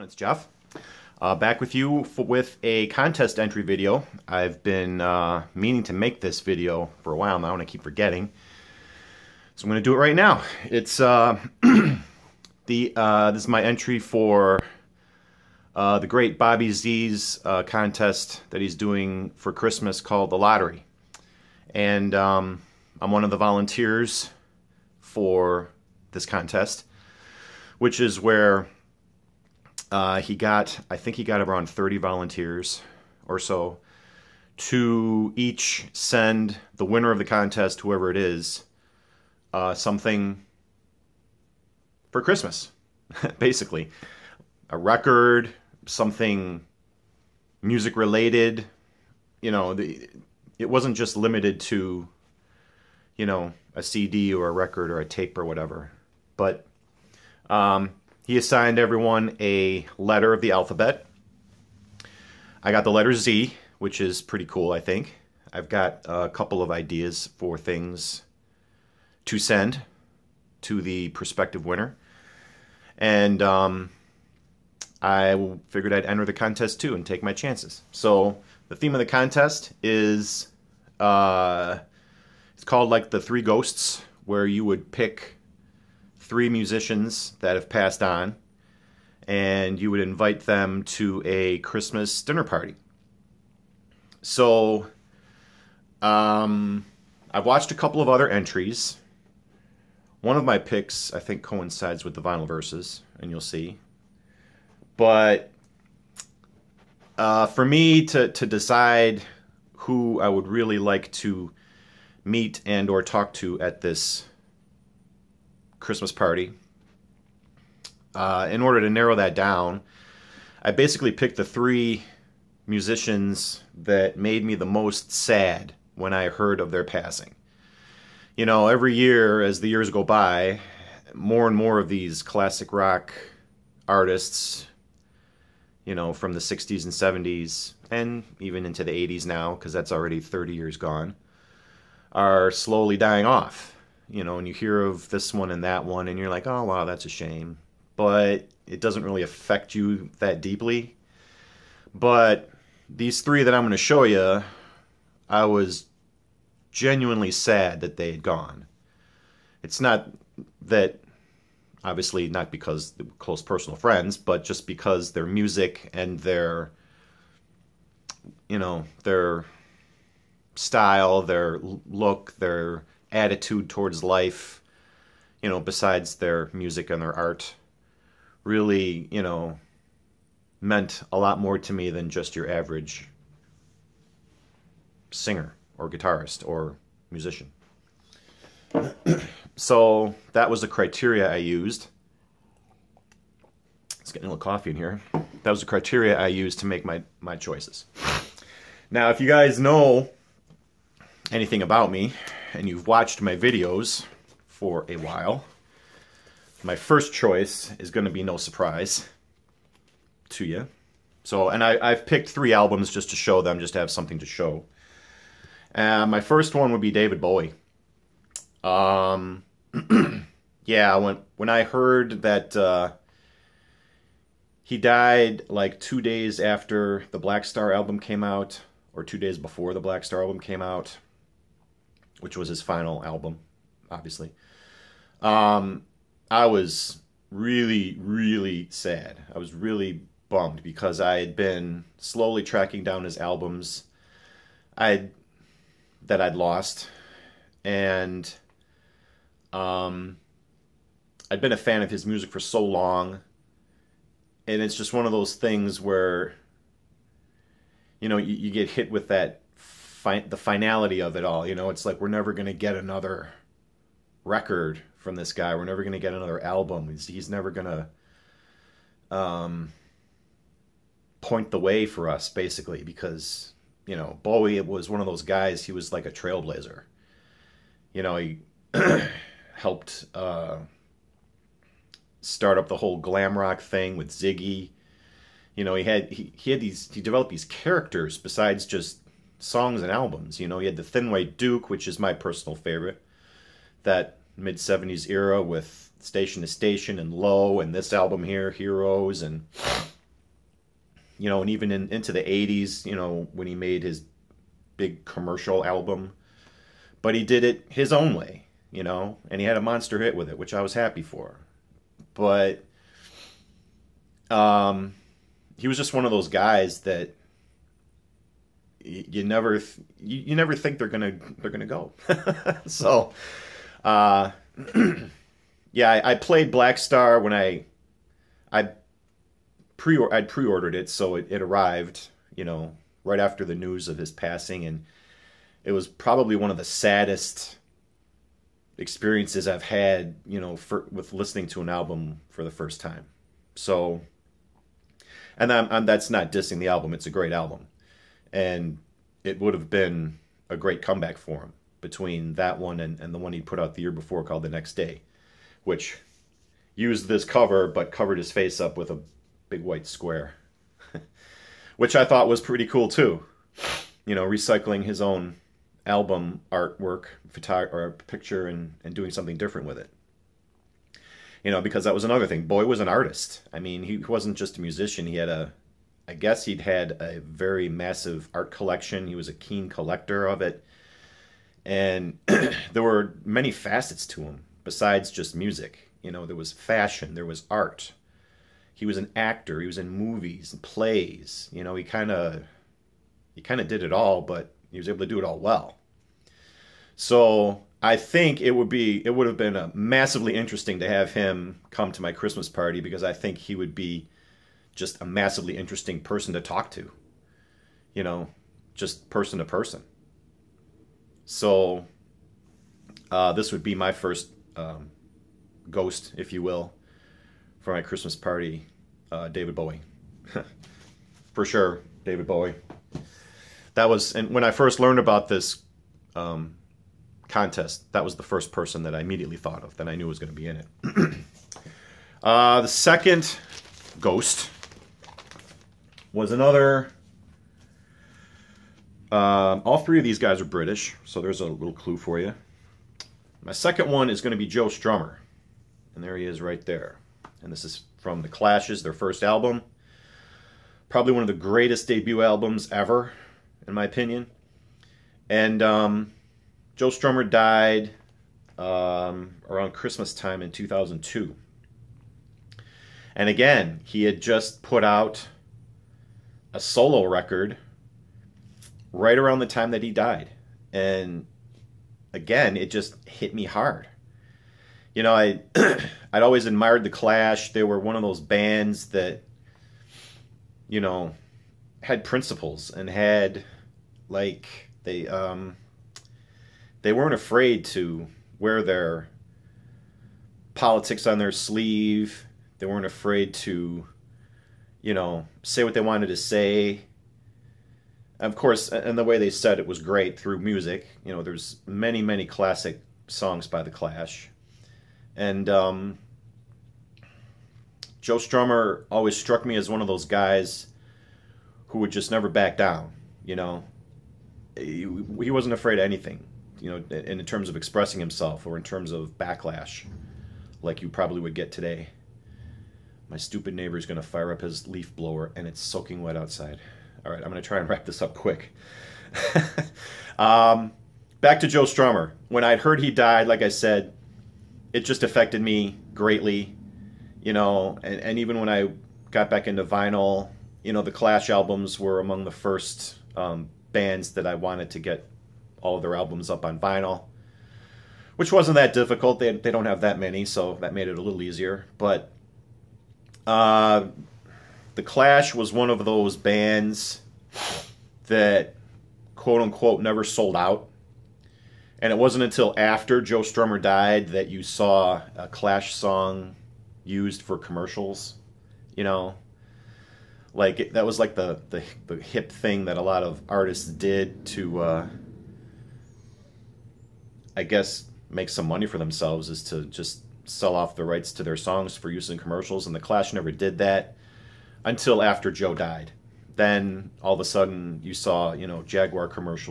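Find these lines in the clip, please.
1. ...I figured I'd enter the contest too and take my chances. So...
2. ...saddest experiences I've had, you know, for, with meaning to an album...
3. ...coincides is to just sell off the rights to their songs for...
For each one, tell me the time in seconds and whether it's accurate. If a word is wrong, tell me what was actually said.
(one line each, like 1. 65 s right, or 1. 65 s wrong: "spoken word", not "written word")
1. 74 s right
2. 336 s wrong: "listening", not "meaning"
3. 578 s wrong: "themselves", not "coincides".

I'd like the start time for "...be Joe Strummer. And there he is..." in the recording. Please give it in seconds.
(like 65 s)
444 s.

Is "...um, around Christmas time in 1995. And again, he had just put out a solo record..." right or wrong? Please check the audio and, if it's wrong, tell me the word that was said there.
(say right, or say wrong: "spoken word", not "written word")
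wrong: "2002", not "1995".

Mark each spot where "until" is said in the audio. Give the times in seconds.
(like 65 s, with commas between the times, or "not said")
562 s, 584 s.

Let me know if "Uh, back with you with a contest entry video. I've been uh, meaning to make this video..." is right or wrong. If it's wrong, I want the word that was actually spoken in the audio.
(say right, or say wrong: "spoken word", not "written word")
right.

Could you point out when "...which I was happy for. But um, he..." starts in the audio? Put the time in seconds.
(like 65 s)
310 s.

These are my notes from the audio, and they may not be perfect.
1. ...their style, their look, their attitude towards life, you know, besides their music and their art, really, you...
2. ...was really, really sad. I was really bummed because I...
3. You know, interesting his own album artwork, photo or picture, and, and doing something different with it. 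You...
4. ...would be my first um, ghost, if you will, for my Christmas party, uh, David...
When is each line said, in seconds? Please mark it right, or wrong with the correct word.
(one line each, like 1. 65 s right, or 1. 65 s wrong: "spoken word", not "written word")
1. 169 s right
2. 236 s right
3. 364 s wrong: "recycling", not "interesting"
4. 413 s right.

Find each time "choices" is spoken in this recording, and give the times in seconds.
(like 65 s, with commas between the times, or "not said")
197 s, 207 s.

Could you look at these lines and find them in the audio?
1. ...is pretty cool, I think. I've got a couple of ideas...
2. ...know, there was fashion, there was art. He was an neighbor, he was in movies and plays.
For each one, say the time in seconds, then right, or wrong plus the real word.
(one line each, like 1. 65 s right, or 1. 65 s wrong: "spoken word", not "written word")
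1. 63 s right
2. 386 s wrong: "actor", not "neighbor".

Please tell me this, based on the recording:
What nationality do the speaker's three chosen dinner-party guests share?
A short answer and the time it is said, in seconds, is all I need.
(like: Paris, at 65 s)
British, at 440 s.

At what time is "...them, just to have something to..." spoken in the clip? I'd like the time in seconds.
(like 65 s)
213 s.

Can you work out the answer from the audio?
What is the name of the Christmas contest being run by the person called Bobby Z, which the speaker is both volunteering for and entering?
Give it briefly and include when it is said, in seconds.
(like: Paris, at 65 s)
The Lottery, at 20 s.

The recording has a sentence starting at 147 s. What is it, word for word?
But it doesn't really affect you that deeply.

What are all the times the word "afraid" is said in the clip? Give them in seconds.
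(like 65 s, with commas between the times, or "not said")
487 s, 492 s, 515 s.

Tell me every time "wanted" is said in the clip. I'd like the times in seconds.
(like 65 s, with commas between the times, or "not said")
495 s, 544 s.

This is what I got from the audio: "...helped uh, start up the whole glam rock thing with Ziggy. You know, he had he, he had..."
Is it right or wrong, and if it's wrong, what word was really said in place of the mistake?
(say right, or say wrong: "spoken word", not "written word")
right.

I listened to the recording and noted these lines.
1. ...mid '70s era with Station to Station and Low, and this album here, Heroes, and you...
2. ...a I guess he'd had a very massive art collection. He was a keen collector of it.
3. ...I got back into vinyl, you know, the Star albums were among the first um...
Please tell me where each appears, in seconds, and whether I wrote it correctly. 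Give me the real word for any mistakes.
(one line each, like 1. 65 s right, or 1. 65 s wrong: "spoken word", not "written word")
1. 294 s right
2. 375 s right
3. 538 s wrong: "Clash", not "Star".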